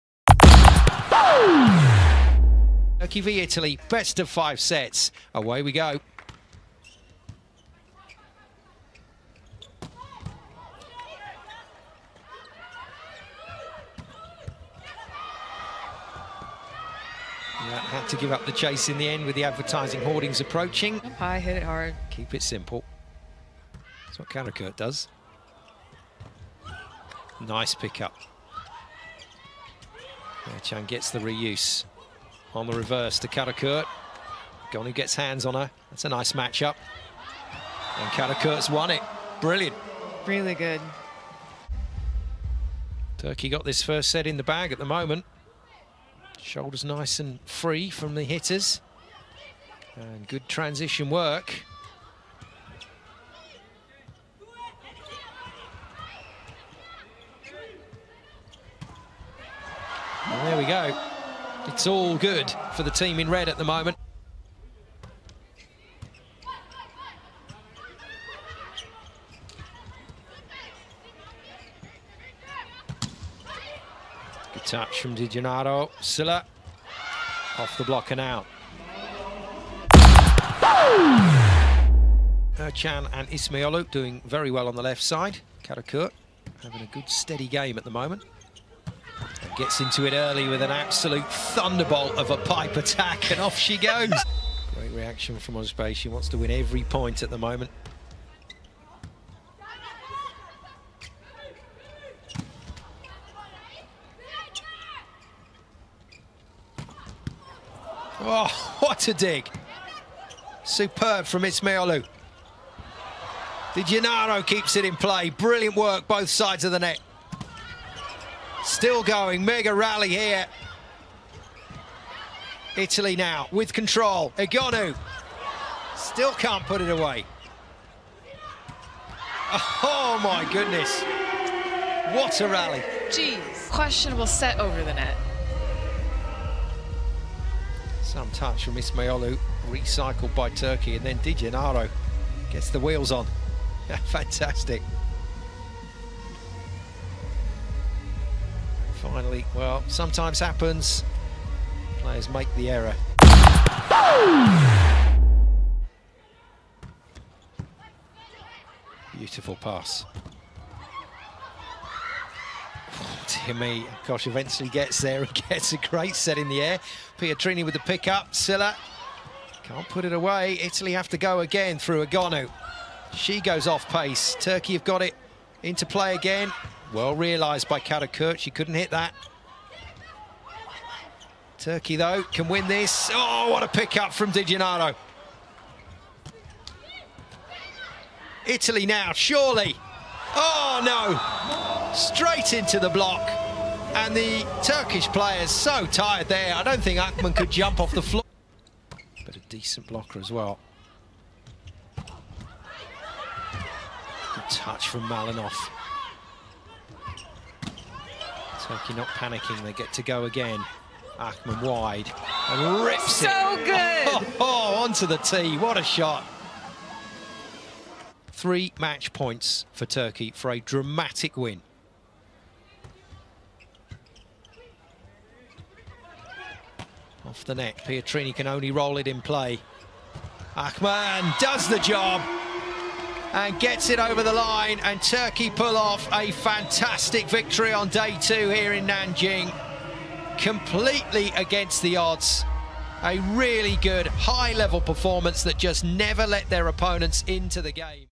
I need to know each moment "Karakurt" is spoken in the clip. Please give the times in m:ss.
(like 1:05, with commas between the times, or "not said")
0:24, 0:33, 0:38, 1:25, 2:57.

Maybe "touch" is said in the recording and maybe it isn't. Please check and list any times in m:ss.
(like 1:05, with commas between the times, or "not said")
1:14, 2:18, 3:24.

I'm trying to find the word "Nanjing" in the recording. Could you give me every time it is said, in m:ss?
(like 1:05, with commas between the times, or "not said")
3:58.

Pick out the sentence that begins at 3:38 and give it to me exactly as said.
Three match points for Turkey for a dramatic win.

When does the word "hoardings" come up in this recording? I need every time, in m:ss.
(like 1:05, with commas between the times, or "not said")
0:20.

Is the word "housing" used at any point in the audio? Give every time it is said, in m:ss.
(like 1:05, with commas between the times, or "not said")
not said.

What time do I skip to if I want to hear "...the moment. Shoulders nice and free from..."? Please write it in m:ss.
0:44.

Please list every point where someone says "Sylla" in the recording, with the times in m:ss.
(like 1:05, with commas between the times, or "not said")
1:16, 2:48.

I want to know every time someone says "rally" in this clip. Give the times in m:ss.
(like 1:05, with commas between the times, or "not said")
1:59, 2:12.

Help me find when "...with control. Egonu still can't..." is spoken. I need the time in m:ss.
2:03.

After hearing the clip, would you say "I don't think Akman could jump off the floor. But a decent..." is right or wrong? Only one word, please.
right.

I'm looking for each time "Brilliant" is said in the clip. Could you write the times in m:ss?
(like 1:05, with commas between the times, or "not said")
0:39, 1:55.